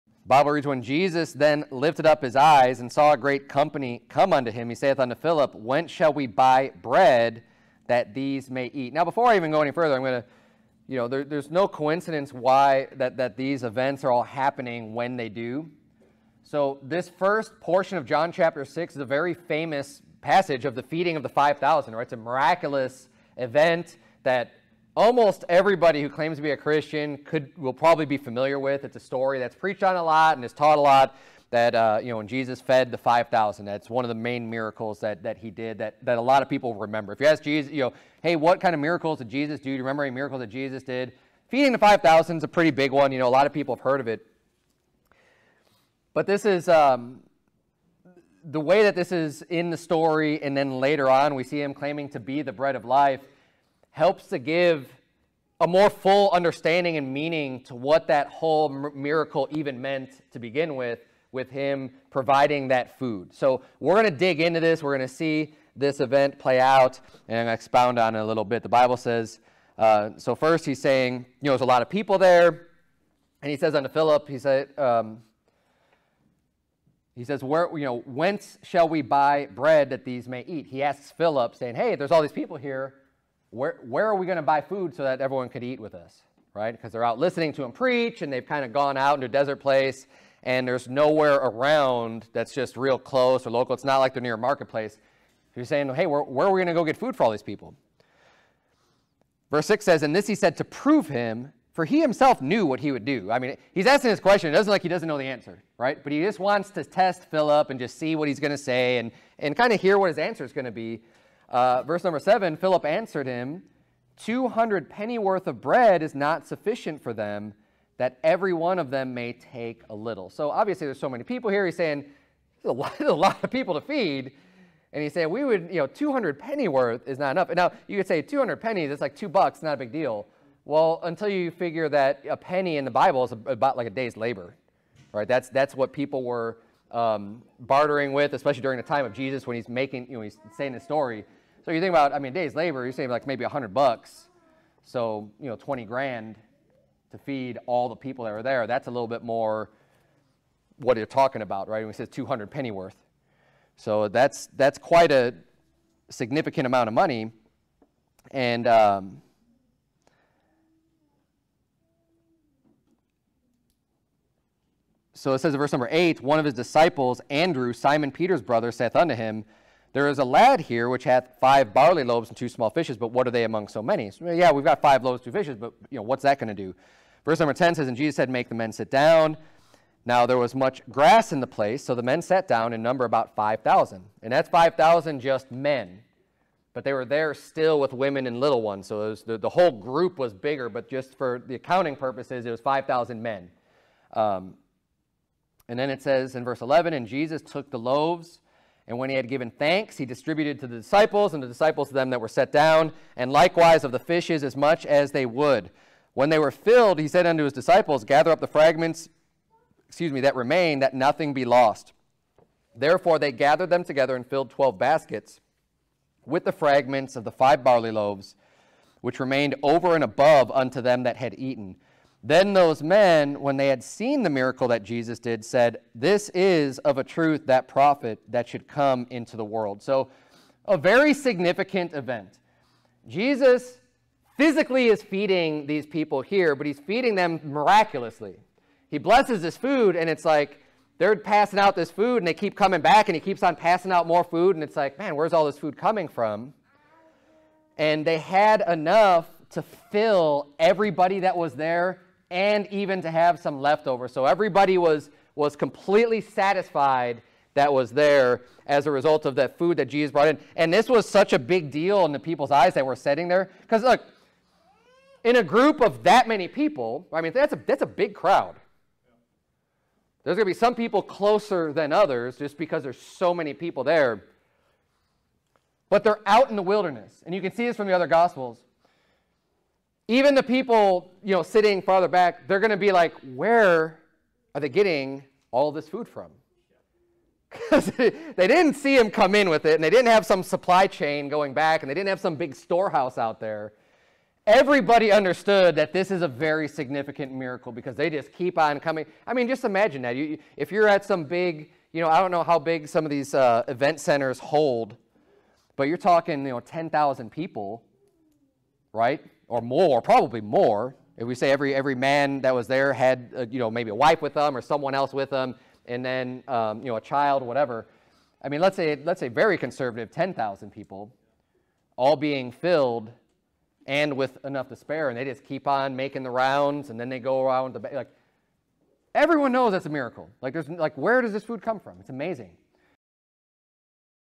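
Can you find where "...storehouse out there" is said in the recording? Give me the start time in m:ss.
4:52.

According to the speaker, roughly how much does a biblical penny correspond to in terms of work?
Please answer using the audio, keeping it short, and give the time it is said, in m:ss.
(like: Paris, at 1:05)
a day's labor, at 2:13.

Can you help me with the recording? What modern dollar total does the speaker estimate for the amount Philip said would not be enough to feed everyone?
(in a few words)
20 grand.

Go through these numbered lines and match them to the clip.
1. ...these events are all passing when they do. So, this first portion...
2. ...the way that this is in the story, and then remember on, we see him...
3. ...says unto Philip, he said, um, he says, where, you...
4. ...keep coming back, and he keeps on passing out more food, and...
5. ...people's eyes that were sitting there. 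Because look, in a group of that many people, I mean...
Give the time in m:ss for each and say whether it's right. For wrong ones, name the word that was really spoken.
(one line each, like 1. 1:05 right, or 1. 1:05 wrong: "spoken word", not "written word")
1. 0:13 wrong: "happening", not "passing"
2. 0:48 wrong: "later", not "remember"
3. 1:13 right
4. 4:02 right
5. 4:22 right.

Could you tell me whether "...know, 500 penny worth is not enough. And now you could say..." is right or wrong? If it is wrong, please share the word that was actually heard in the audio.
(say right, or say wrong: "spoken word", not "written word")
wrong: "200", not "500".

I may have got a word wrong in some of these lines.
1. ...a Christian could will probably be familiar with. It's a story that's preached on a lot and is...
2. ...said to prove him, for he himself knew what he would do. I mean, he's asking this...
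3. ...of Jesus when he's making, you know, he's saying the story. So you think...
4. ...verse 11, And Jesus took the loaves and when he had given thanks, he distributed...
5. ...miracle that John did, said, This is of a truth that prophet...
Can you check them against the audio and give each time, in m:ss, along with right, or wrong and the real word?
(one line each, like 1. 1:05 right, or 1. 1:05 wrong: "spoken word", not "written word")
1. 0:26 right
2. 1:40 right
3. 2:19 right
4. 3:16 right
5. 3:44 wrong: "Jesus", not "John".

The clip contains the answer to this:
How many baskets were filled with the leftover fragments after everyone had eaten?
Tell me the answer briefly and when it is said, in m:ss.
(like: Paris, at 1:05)
12, at 3:34.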